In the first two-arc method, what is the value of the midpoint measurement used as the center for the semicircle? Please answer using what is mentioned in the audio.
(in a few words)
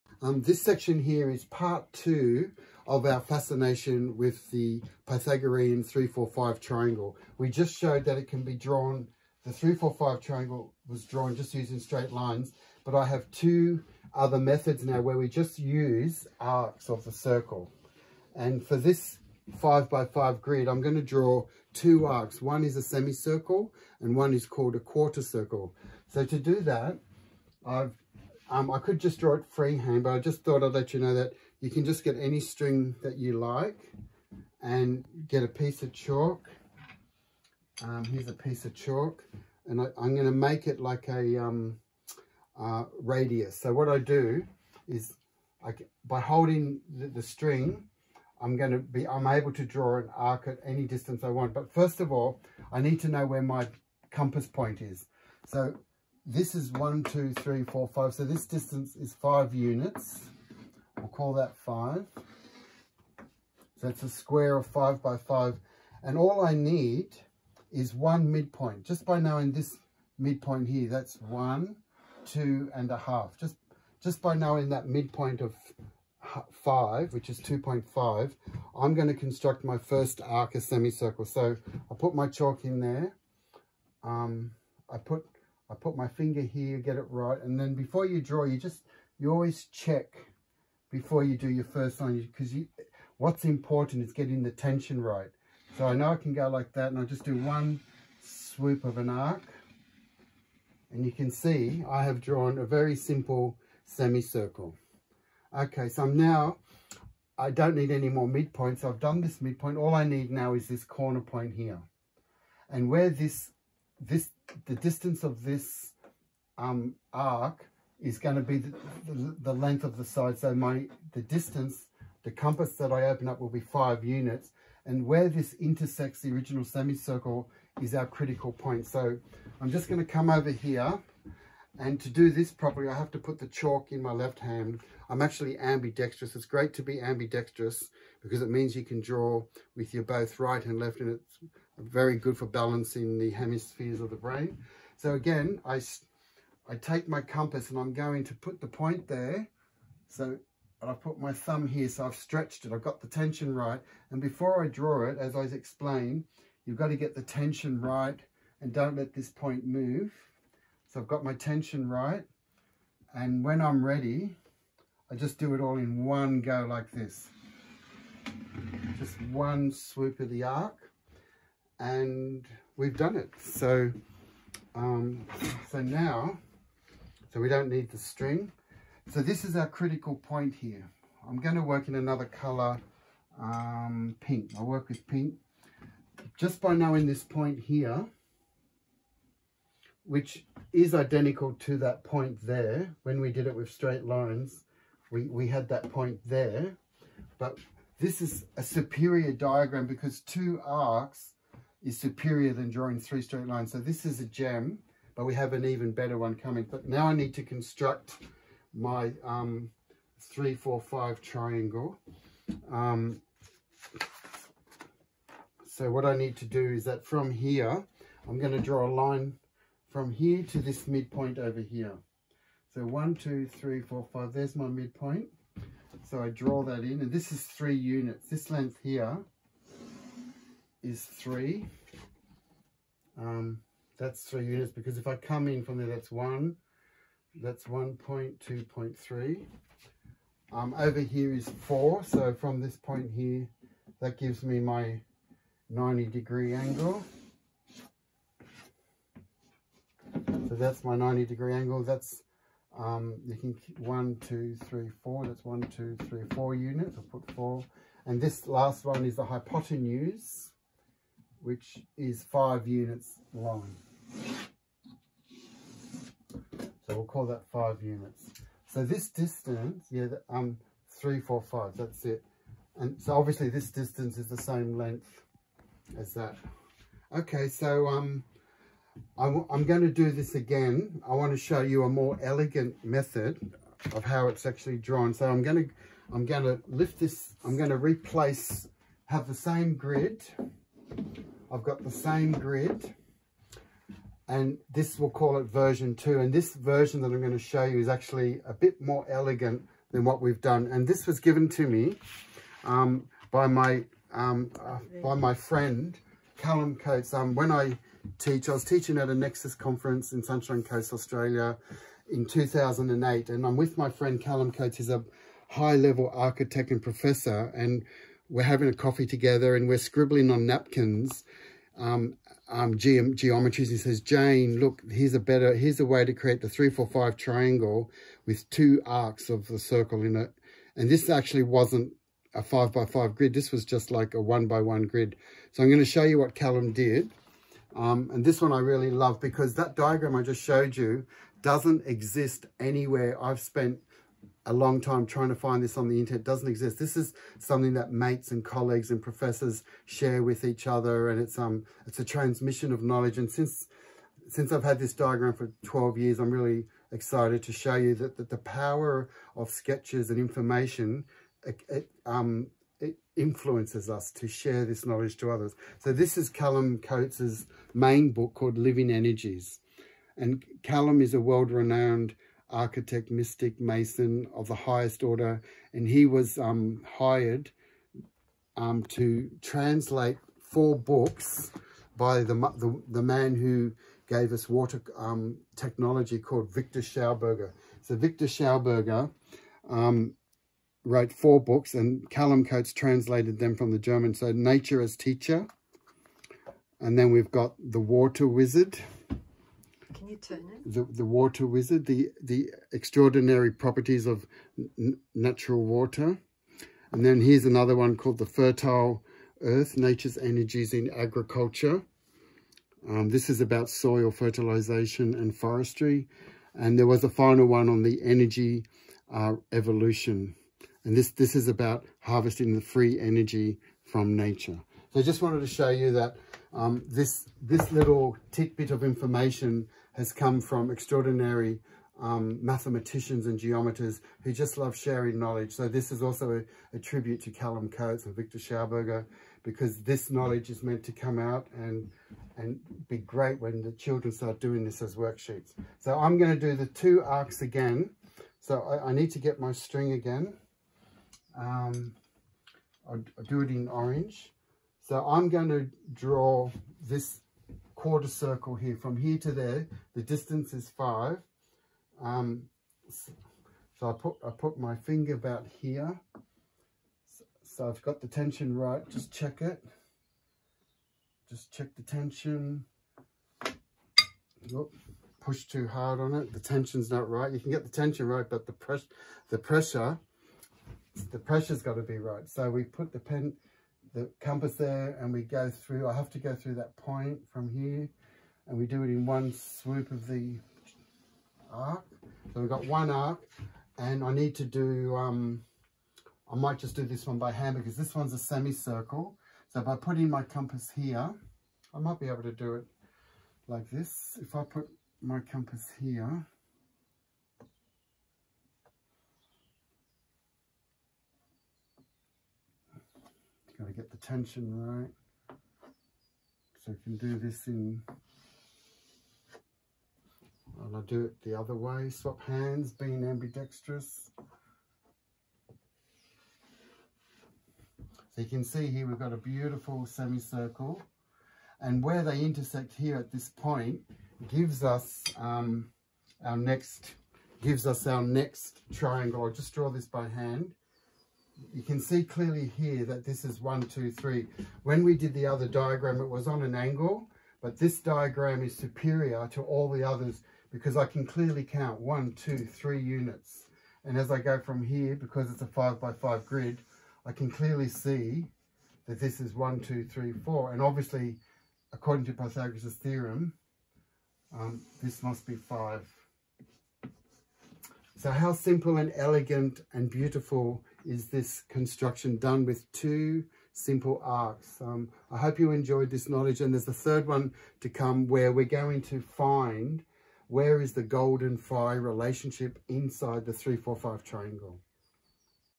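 2.5.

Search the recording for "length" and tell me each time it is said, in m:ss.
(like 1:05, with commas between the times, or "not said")
1:59, 3:48, 4:34.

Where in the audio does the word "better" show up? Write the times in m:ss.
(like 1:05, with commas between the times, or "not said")
3:25, 5:25.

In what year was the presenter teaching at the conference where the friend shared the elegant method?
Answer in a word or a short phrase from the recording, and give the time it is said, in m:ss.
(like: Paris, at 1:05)
2008, at 5:12.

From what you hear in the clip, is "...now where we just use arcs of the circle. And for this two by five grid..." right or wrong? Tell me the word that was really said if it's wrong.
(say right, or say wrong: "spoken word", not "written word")
wrong: "five", not "two".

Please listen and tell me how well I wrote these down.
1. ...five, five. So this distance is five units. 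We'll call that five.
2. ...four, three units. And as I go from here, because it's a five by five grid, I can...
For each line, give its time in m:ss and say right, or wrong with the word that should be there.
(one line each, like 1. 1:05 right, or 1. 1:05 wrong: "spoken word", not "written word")
1. 0:57 wrong: "four", not "five"
2. 9:12 wrong: "two", not "four".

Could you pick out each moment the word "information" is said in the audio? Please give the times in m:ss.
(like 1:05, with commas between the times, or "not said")
6:00, 7:08.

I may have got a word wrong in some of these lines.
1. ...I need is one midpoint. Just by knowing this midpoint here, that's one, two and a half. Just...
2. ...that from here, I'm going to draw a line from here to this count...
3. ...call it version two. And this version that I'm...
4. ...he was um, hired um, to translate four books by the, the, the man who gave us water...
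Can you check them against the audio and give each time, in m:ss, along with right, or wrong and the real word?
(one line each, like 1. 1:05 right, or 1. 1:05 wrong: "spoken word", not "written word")
1. 1:06 right
2. 3:36 wrong: "midpoint", not "count"
3. 4:55 right
4. 6:15 right.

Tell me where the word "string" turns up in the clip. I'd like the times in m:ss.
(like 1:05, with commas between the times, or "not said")
0:32, 0:47, 2:57, 7:29.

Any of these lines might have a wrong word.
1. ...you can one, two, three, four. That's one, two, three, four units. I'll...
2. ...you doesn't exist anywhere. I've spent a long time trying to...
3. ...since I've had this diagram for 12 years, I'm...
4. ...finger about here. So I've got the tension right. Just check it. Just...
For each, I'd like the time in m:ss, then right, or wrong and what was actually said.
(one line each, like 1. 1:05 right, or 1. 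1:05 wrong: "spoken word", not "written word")
1. 4:13 right
2. 5:40 right
3. 5:54 right
4. 7:44 right.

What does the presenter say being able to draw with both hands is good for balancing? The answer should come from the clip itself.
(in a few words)
The hemispheres of the brain.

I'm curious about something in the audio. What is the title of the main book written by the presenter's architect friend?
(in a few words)
Living Energies.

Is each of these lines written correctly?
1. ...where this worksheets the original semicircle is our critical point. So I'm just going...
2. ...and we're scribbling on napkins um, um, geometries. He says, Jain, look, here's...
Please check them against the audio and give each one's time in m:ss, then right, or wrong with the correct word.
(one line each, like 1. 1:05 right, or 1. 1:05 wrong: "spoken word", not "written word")
1. 2:05 wrong: "intersects", not "worksheets"
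2. 5:19 right.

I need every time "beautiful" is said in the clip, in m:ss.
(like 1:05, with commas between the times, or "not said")
8:49, 9:29.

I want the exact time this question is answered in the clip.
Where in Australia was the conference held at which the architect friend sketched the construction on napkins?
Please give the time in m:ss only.
5:10.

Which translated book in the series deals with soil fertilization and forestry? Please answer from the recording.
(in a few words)
The Fertile Earth.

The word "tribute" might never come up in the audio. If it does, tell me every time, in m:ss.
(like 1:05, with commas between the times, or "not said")
7:16.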